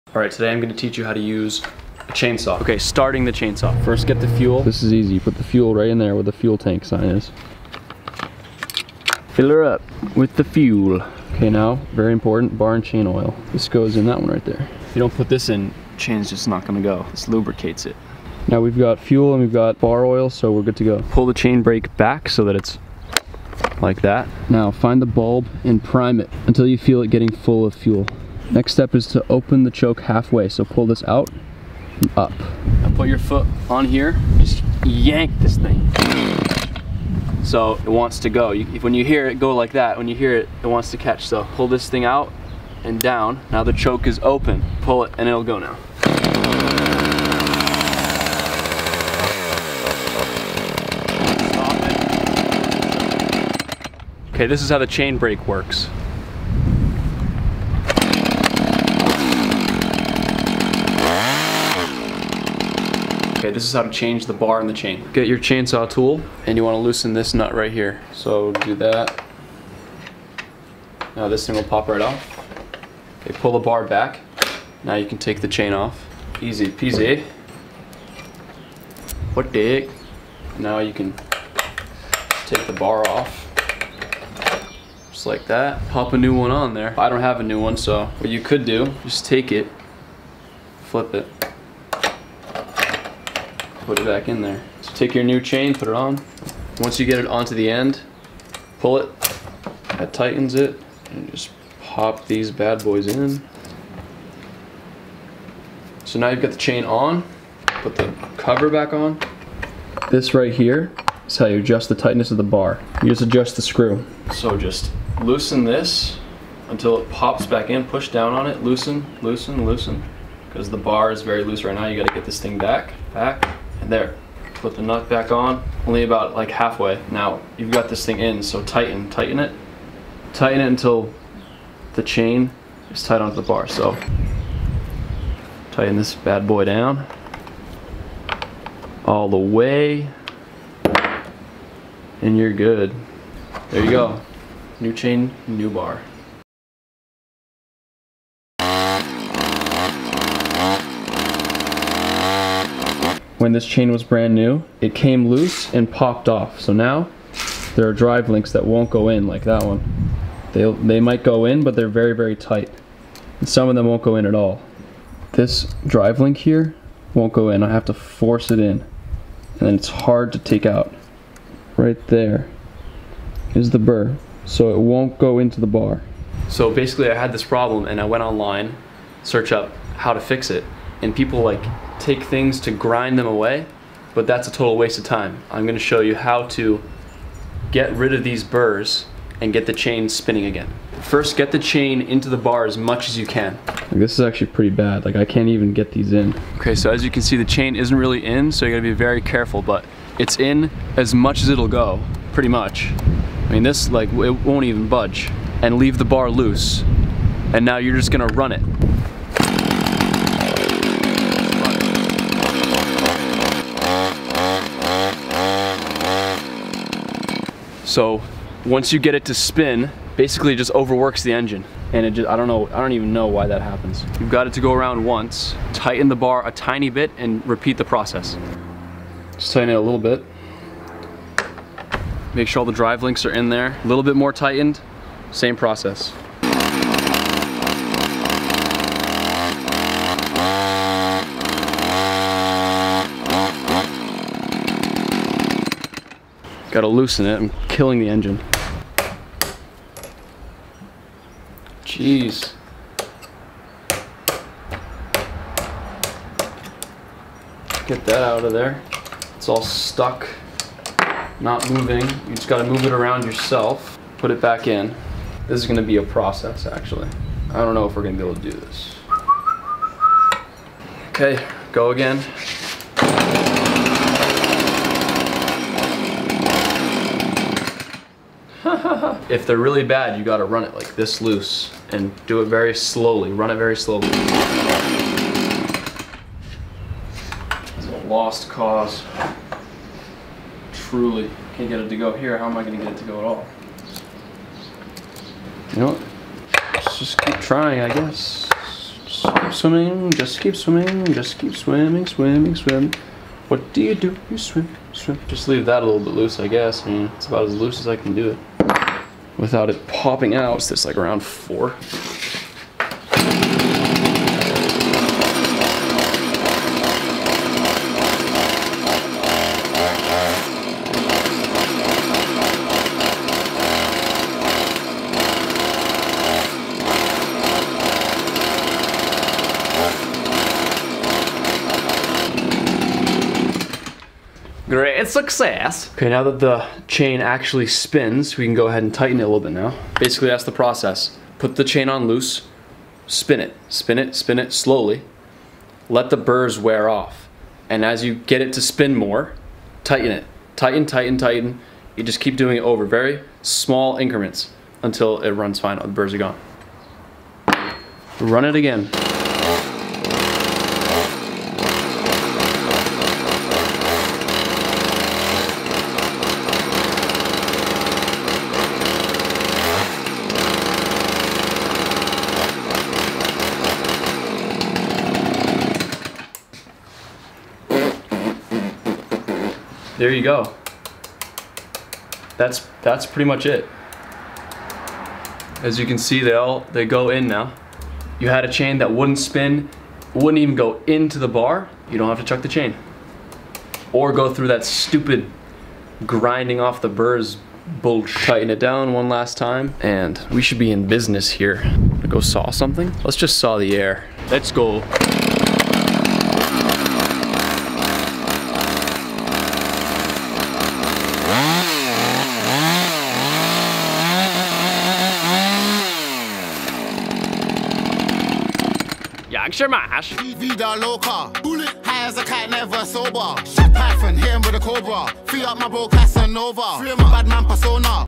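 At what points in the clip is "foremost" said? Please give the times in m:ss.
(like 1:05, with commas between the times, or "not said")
not said.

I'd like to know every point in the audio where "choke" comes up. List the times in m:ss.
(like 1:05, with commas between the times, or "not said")
0:29, 0:43.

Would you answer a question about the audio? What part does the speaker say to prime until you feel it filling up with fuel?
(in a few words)
the bulb.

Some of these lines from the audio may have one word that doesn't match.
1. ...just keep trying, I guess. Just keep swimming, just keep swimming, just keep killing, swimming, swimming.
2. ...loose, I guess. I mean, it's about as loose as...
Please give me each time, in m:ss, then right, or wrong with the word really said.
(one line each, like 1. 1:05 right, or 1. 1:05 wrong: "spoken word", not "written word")
1. 4:56 wrong: "swimming", not "killing"
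2. 5:06 right.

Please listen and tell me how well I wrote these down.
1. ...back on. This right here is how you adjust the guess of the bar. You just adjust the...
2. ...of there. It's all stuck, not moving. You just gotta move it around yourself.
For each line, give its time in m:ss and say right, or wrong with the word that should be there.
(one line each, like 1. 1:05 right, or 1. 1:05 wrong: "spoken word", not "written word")
1. 1:48 wrong: "tightness", not "guess"
2. 4:18 right.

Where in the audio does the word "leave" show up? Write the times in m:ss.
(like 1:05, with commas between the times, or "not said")
3:25, 5:05.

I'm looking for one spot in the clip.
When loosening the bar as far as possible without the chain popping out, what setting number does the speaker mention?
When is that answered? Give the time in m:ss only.
5:11.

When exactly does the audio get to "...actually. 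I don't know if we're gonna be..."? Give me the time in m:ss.
4:26.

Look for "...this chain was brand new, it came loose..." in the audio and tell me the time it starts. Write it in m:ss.
2:33.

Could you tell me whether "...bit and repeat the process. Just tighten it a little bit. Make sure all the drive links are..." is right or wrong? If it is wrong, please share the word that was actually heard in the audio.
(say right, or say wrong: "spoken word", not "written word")
right.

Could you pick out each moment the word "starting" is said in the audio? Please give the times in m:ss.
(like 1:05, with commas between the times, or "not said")
0:02.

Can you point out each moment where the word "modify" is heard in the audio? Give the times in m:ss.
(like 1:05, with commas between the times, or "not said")
not said.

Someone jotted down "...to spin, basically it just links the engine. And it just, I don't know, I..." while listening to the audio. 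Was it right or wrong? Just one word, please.
wrong.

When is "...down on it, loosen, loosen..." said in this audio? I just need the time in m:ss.
1:58.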